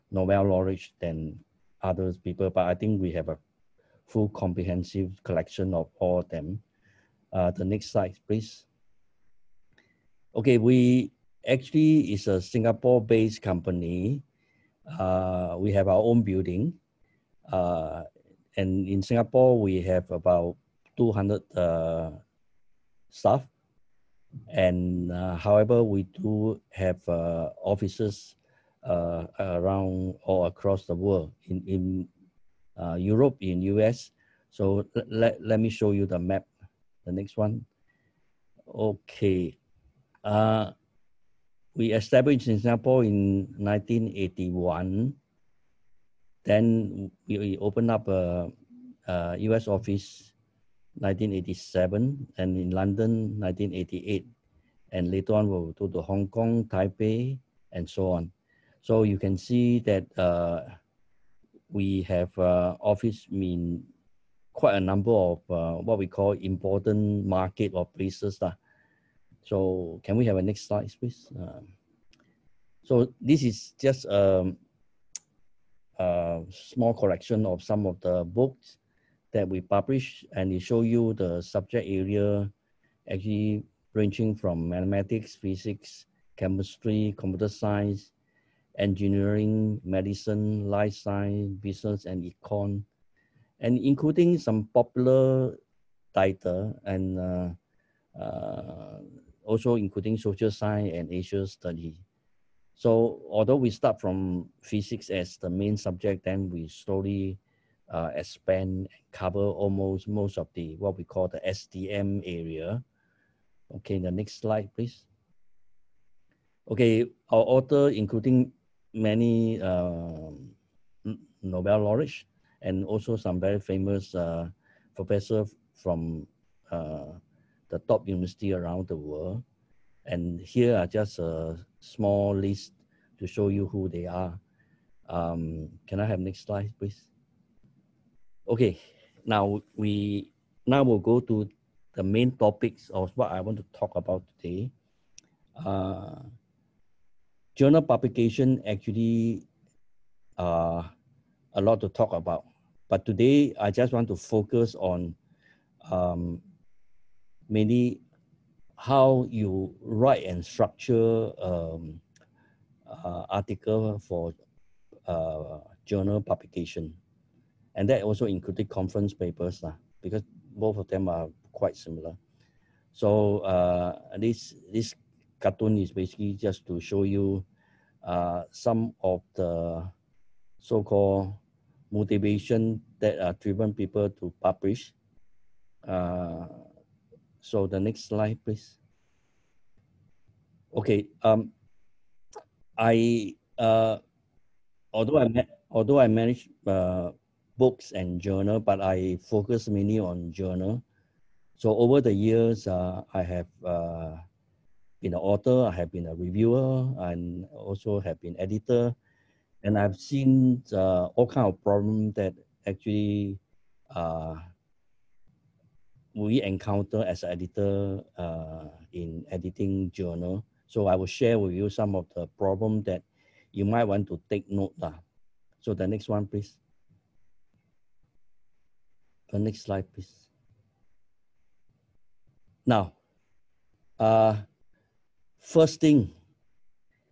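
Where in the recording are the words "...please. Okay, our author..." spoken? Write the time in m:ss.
1:54.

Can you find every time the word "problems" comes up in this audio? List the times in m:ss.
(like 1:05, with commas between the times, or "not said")
3:31, 3:42.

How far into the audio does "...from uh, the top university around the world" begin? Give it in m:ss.
2:05.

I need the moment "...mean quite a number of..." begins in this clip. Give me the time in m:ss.
1:03.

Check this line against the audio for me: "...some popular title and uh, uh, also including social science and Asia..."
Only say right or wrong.
right.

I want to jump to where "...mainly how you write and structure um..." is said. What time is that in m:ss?
2:37.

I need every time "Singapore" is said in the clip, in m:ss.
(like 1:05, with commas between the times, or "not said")
0:12, 0:19, 0:42.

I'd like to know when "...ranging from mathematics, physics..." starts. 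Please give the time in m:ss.
1:23.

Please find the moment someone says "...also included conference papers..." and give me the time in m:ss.
2:48.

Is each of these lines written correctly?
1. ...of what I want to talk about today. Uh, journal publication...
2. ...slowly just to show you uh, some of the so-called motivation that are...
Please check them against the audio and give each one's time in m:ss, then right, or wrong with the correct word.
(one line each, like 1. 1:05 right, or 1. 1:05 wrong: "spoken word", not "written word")
1. 2:22 right
2. 2:55 wrong: "basically", not "slowly".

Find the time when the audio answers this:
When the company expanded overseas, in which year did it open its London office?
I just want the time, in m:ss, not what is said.
0:53.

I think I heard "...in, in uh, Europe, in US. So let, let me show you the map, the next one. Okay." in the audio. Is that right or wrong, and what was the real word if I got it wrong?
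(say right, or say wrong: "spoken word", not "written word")
right.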